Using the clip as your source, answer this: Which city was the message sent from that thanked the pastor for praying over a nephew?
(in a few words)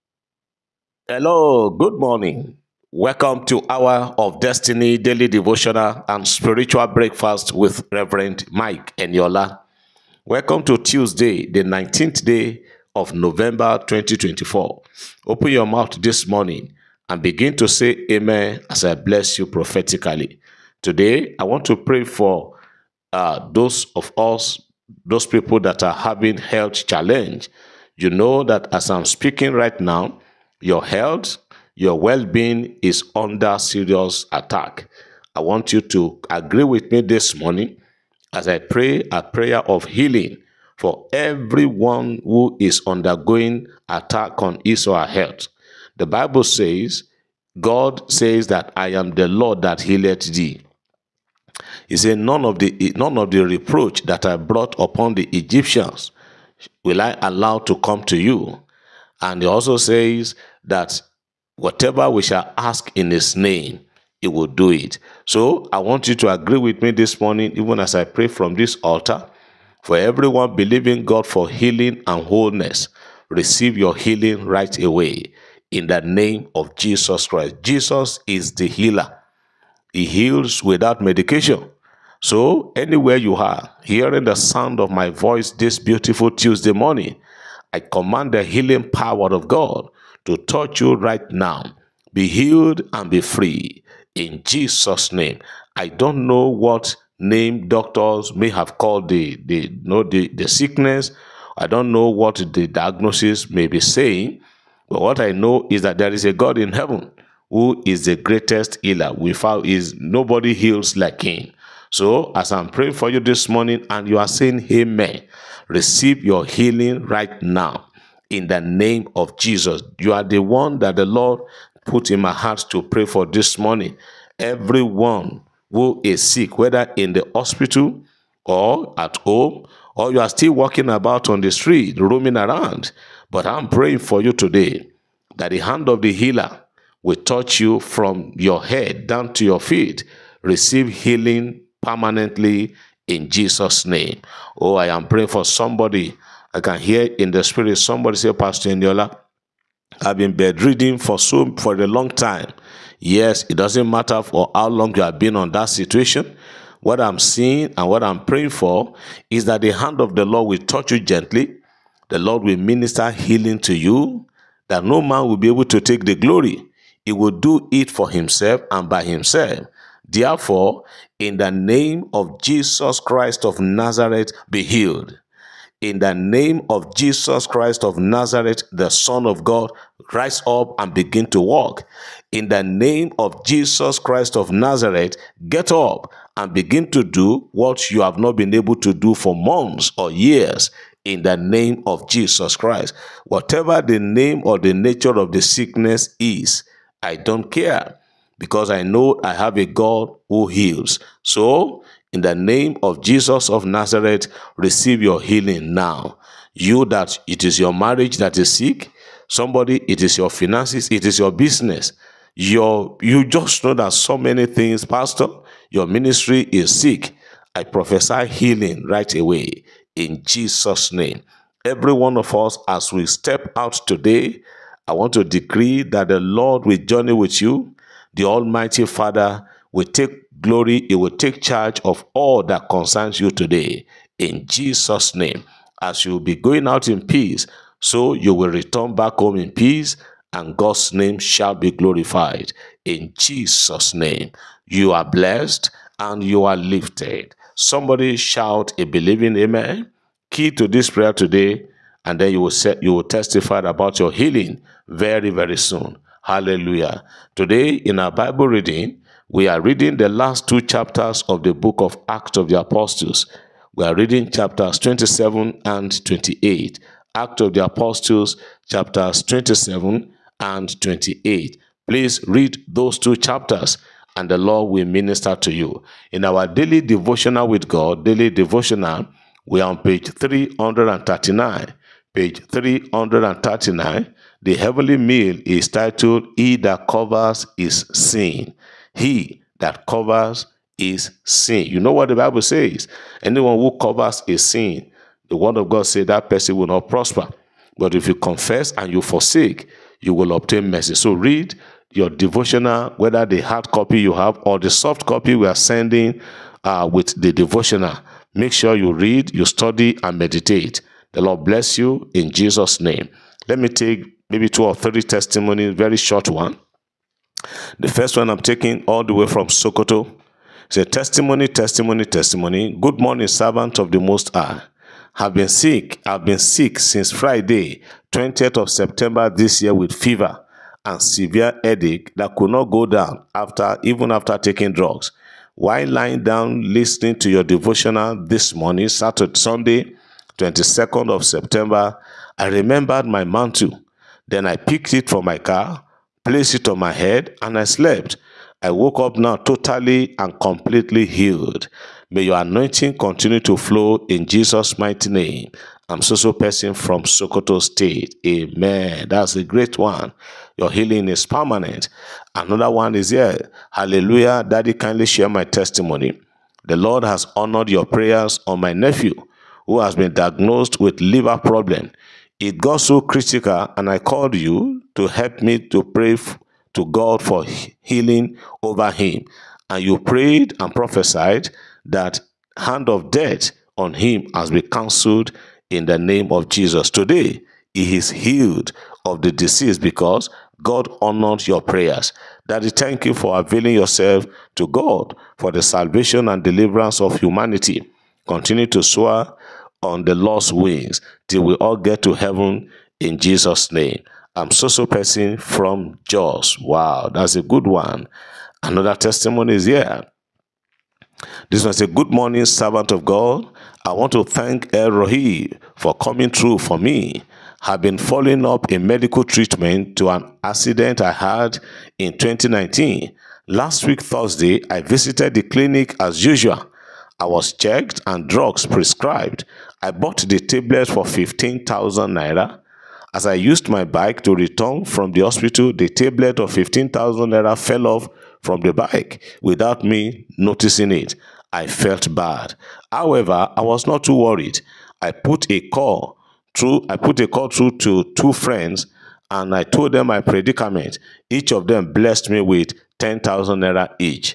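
Jos.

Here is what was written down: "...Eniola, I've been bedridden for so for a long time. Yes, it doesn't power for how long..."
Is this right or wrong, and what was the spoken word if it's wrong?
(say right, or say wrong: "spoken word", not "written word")
wrong: "matter", not "power".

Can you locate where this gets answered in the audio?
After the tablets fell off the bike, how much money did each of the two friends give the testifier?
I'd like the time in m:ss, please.
7:32.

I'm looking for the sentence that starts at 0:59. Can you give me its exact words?
And he also says that whatever we shall ask in his name, he will do it.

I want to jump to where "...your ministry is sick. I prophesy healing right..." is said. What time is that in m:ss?
3:35.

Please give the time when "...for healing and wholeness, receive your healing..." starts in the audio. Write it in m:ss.
1:11.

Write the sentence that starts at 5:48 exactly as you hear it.
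I woke up now totally and completely healed.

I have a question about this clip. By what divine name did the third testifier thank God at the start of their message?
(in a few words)
El Roi.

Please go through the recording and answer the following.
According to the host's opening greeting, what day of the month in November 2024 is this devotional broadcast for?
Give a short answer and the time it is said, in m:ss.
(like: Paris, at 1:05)
19, at 0:11.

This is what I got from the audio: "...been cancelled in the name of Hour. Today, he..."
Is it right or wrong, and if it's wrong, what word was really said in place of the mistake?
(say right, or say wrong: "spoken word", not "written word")
wrong: "Jesus", not "Hour".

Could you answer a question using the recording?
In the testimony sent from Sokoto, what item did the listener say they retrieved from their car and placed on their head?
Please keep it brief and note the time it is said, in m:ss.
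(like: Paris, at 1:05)
Mantle, at 5:43.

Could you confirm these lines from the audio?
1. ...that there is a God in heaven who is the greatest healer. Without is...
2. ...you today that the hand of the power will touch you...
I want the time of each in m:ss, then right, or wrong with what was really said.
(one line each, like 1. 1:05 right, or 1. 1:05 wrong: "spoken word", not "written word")
1. 1:45 right
2. 2:14 wrong: "healer", not "power".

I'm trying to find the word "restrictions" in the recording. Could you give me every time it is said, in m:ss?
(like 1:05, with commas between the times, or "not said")
not said.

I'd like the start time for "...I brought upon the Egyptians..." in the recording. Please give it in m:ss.
0:54.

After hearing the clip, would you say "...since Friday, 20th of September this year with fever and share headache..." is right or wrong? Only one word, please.
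wrong.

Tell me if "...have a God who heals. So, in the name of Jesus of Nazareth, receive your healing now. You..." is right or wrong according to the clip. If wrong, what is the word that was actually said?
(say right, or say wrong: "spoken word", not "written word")
right.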